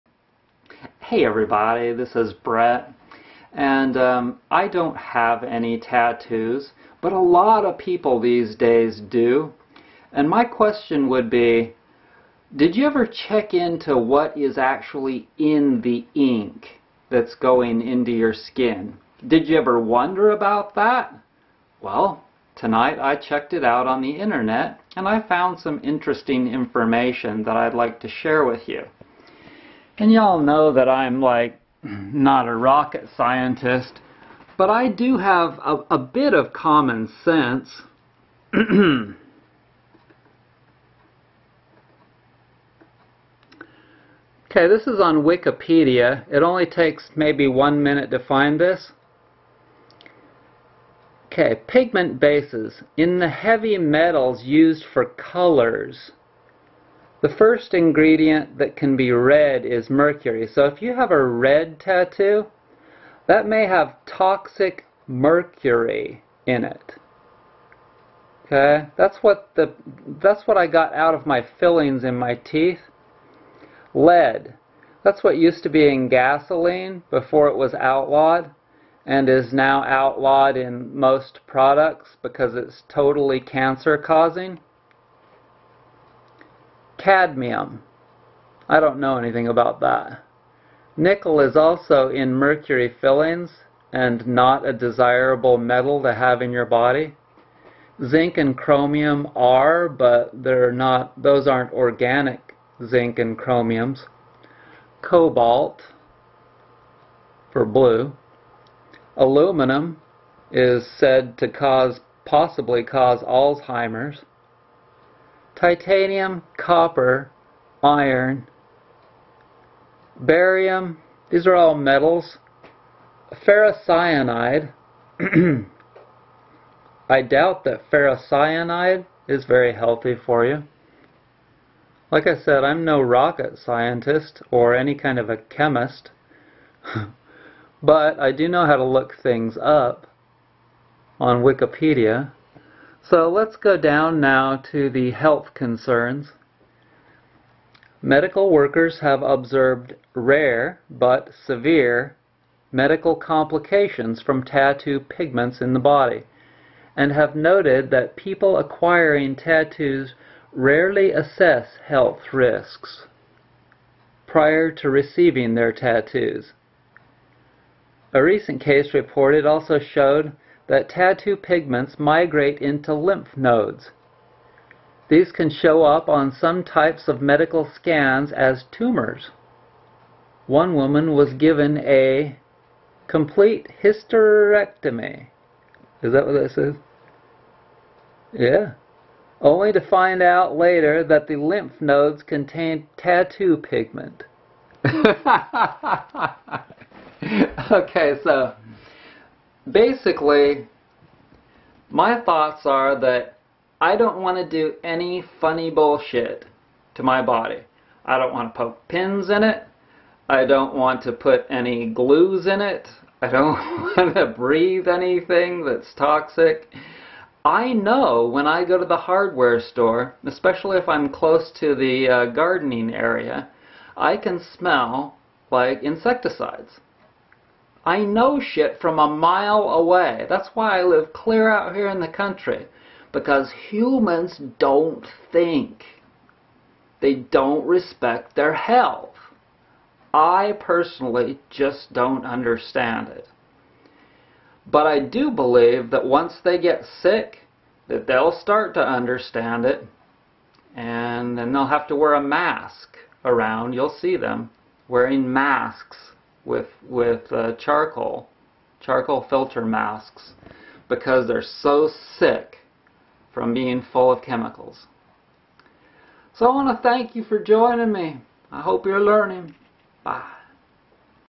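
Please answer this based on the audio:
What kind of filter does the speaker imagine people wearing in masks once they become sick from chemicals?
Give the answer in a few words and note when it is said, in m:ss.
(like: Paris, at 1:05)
Charcoal, at 4:18.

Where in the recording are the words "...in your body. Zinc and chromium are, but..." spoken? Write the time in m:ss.
1:36.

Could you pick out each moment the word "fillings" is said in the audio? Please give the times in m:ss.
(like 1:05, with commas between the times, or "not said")
1:11, 1:33.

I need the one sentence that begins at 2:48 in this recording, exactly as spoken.
A recent case reported also showed that tattoo pigments migrate into lymph nodes.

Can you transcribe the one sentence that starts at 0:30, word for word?
And y'all know that I'm like not a rocket scientist, but I do have a, a bit of common sense.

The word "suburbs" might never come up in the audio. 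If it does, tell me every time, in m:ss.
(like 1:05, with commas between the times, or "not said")
not said.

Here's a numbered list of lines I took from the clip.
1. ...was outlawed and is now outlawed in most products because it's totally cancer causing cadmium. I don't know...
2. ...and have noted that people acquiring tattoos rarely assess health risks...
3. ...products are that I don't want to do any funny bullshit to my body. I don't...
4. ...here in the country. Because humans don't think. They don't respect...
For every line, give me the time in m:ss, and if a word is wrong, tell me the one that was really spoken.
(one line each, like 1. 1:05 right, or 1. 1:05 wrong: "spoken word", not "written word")
1. 1:17 right
2. 2:36 right
3. 3:22 wrong: "thoughts", not "products"
4. 3:51 right.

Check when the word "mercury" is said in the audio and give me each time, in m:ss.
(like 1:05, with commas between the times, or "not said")
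0:59, 1:05, 1:32.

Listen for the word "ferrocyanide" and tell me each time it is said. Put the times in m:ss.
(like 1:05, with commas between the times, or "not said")
2:03, 2:07.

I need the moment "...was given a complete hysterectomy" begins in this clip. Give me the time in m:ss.
3:01.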